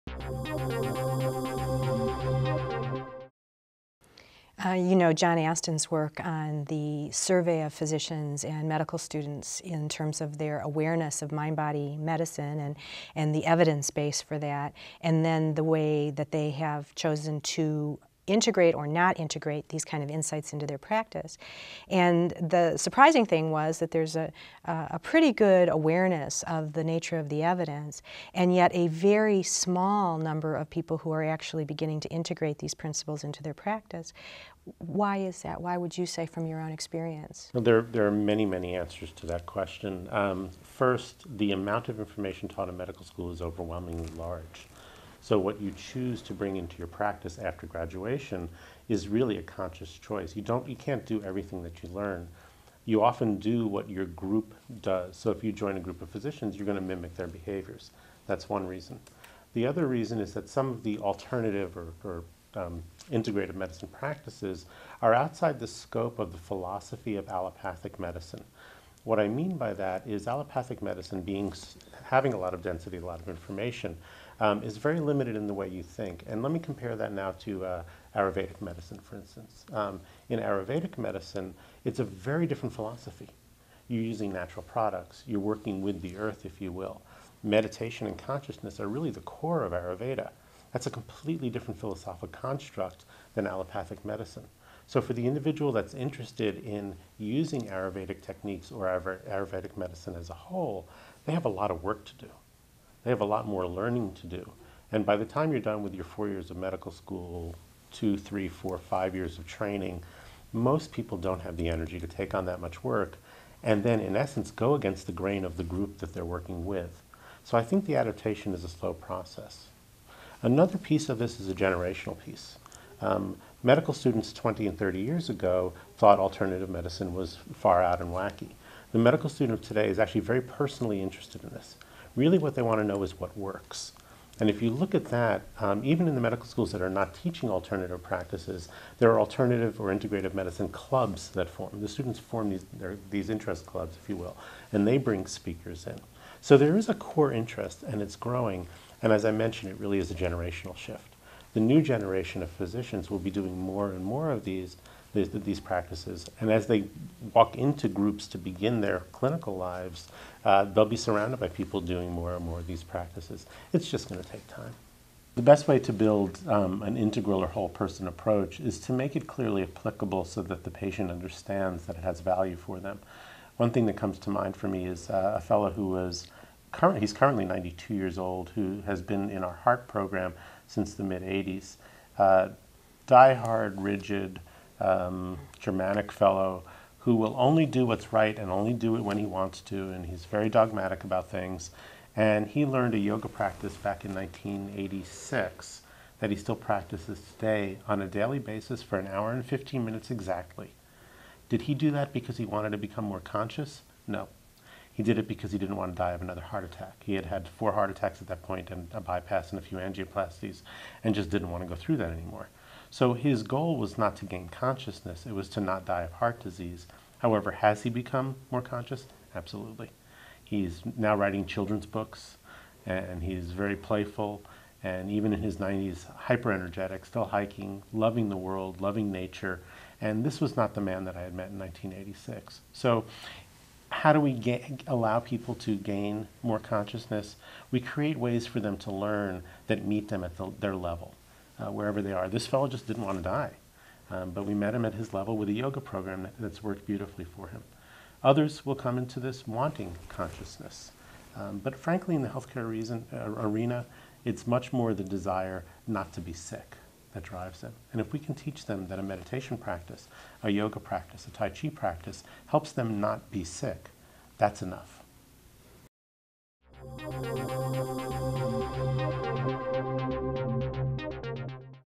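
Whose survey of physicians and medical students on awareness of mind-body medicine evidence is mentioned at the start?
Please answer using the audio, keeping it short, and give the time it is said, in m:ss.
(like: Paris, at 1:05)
John Astin, at 0:05.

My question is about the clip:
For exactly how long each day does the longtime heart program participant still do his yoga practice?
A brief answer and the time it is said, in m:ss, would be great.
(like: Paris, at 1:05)
1 hour 15 minutes, at 3:18.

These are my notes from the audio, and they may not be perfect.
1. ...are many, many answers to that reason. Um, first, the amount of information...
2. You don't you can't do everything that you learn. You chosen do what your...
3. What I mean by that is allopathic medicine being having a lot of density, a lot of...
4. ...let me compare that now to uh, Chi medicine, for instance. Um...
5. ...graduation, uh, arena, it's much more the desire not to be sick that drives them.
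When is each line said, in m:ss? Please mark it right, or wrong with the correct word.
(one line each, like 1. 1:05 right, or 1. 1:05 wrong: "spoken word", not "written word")
1. 0:38 wrong: "question", not "reason"
2. 0:50 wrong: "often", not "chosen"
3. 1:09 right
4. 1:16 wrong: "Ayurvedic", not "Chi"
5. 4:12 wrong: "reason", not "graduation".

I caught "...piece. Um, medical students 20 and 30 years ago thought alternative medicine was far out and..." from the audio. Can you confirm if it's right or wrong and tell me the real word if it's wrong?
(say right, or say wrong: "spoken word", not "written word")
right.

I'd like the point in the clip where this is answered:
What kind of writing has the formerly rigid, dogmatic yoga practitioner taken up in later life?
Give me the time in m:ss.
3:41.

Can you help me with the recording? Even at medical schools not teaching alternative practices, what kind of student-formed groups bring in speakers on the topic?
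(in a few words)
integrative medicine clubs.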